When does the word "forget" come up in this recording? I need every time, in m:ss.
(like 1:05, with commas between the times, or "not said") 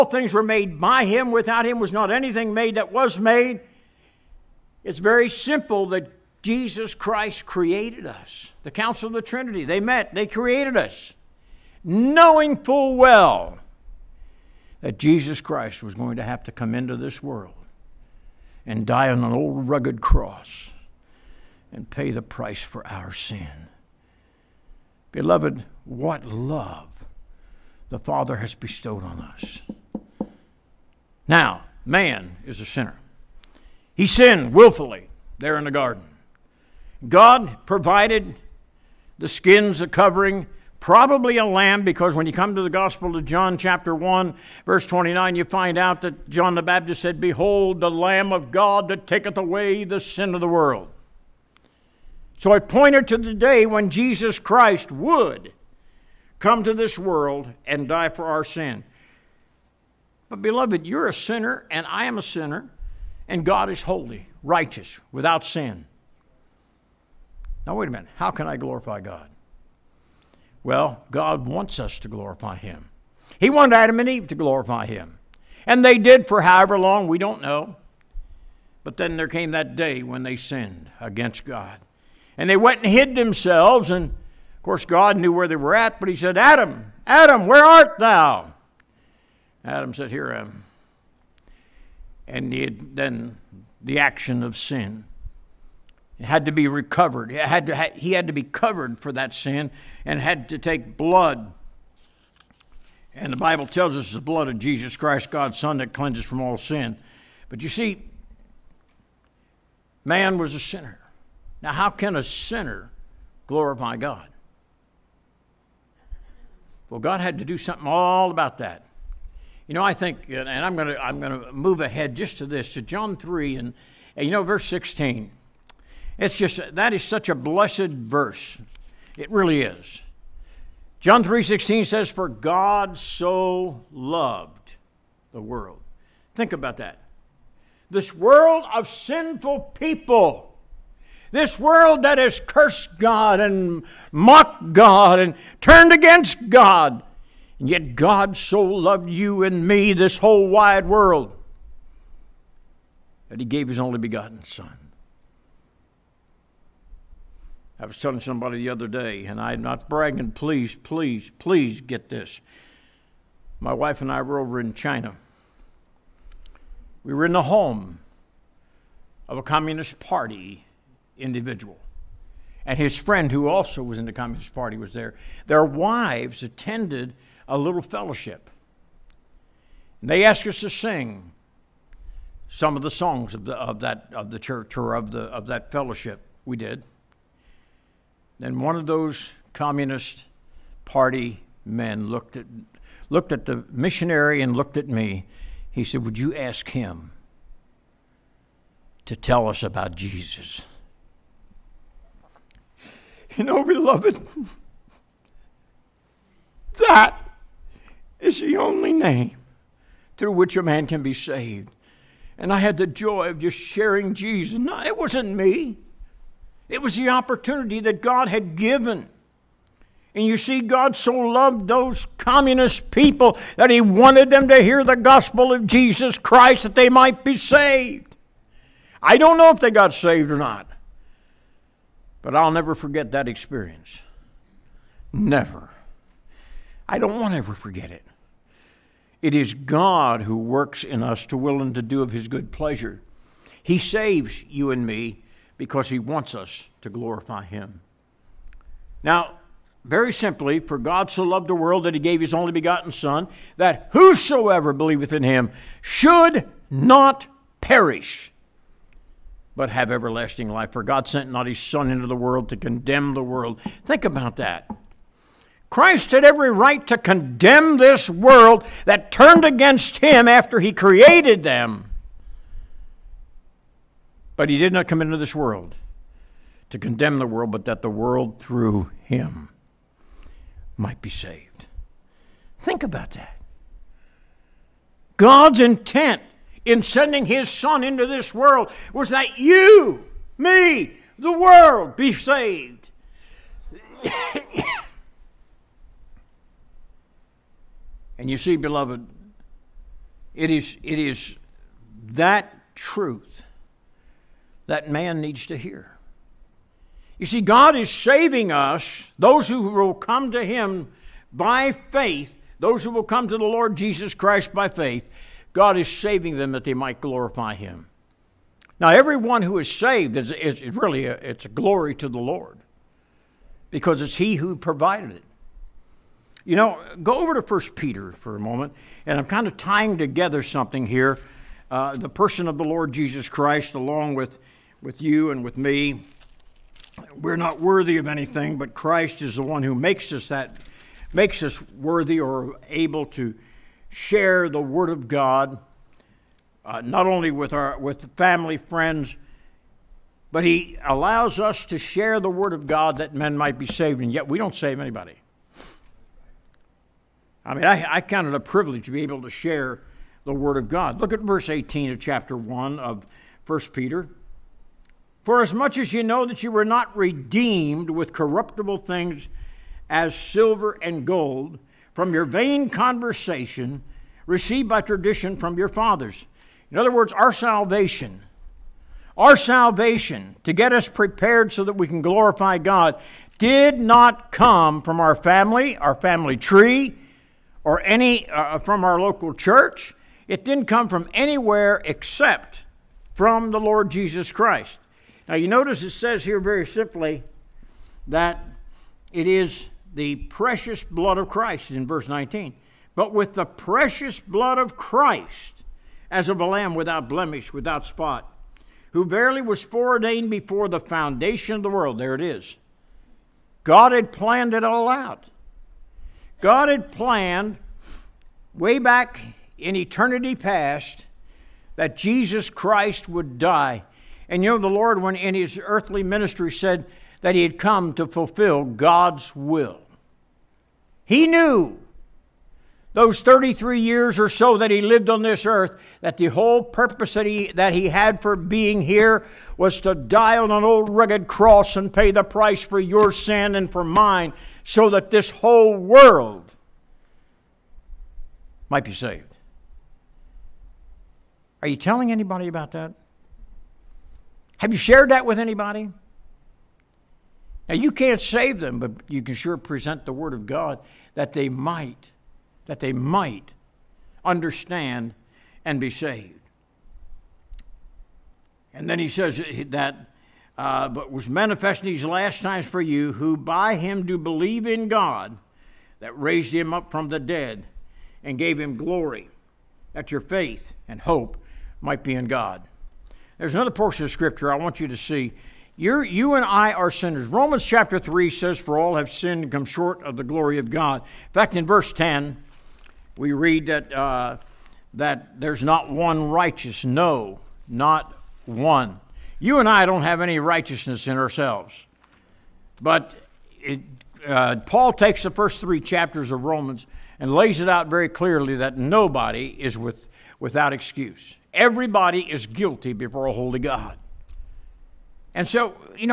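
3:52, 3:57.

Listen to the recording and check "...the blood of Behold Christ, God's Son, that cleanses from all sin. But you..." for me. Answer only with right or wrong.
wrong.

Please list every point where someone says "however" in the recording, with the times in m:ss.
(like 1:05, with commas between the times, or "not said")
1:16.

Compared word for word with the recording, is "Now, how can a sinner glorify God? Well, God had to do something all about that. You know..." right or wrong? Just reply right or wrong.
right.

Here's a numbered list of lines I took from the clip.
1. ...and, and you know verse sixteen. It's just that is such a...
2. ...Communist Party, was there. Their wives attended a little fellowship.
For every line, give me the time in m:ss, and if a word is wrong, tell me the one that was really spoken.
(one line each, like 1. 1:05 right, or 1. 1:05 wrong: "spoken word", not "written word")
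1. 2:03 right
2. 2:54 right.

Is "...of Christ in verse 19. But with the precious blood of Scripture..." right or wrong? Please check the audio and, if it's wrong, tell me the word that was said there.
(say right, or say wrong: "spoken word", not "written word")
wrong: "Christ", not "Scripture".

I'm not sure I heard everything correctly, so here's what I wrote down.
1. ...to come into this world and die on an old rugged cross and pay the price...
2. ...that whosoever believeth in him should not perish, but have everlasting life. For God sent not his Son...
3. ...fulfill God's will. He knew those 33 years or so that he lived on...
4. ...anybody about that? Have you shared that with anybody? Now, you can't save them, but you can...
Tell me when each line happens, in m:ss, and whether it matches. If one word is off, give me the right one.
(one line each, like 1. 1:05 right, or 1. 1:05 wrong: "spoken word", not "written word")
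1. 0:16 right
2. 4:13 right
3. 7:08 right
4. 7:32 right.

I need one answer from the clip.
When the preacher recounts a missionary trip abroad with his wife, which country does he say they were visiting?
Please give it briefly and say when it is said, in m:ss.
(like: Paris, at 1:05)
China, at 2:44.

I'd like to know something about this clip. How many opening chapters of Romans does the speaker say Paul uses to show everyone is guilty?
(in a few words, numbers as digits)
3.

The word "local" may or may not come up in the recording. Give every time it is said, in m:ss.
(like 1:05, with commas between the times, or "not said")
6:28.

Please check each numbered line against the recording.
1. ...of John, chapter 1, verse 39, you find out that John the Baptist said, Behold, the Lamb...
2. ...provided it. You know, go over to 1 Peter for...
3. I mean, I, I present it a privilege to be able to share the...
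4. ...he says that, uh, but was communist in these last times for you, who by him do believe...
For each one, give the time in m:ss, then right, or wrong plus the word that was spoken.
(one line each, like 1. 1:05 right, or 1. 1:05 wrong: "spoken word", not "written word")
1. 0:43 wrong: "29", not "39"
2. 5:24 right
3. 5:57 wrong: "count", not "present"
4. 7:48 wrong: "manifest", not "communist".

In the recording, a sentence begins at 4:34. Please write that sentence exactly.
But he did not come into this world to condemn the world, but that the world through him might be saved.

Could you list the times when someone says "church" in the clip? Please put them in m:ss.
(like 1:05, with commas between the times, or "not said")
3:04, 6:29.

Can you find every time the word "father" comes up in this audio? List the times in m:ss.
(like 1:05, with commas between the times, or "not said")
0:27, 6:15.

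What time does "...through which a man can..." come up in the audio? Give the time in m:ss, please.
3:30.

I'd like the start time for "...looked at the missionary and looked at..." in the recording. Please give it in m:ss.
3:13.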